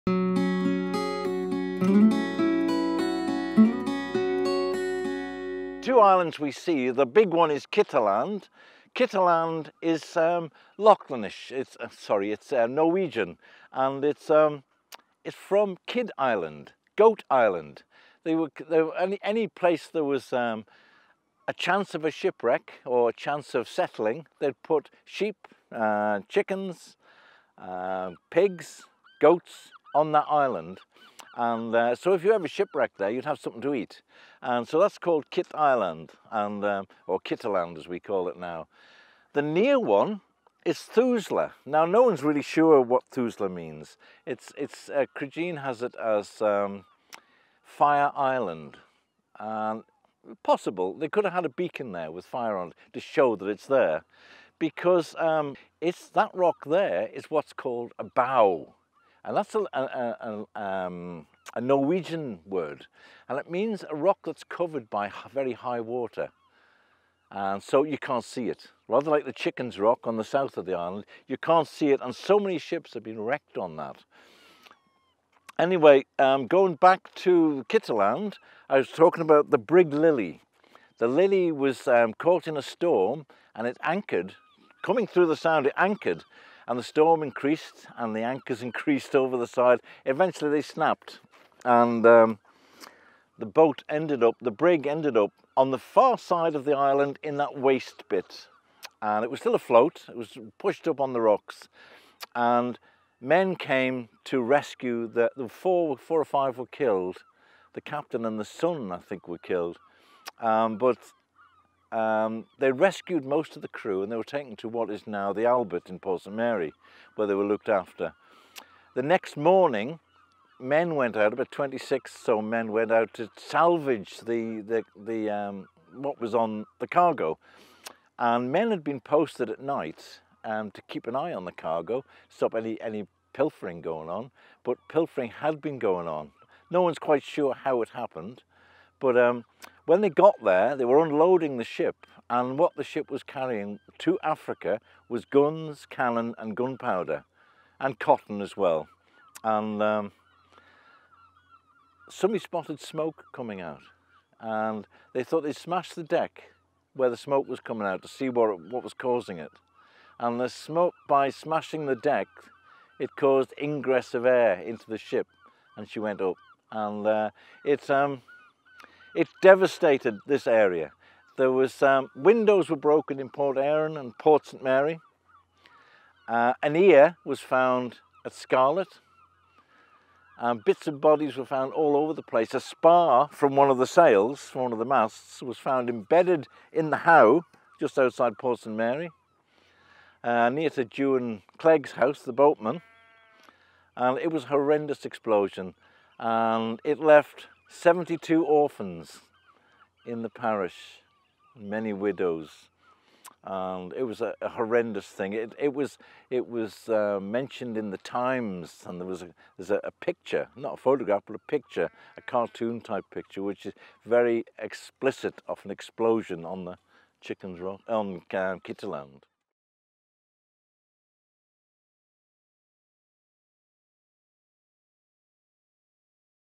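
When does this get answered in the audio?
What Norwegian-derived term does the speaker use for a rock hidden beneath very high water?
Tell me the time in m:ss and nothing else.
0:58.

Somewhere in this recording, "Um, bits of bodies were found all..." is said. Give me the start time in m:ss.
3:00.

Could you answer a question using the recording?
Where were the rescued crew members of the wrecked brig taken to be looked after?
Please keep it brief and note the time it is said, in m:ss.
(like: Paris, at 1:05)
the Albert in Port St Mary, at 1:55.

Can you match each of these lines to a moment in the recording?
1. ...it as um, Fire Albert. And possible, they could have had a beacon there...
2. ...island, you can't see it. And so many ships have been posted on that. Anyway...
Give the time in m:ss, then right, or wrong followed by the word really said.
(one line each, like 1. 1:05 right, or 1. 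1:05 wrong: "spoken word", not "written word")
1. 0:45 wrong: "Island", not "Albert"
2. 1:10 wrong: "wrecked", not "posted".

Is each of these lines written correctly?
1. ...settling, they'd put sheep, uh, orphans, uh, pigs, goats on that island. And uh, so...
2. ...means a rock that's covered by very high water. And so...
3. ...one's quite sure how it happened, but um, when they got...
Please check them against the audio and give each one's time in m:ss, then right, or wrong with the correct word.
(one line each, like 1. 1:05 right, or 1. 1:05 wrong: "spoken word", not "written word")
1. 0:23 wrong: "chickens", not "orphans"
2. 1:03 right
3. 2:16 right.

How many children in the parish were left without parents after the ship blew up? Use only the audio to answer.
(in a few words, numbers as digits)
72.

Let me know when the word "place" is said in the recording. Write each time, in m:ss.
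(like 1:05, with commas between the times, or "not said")
0:19, 3:02.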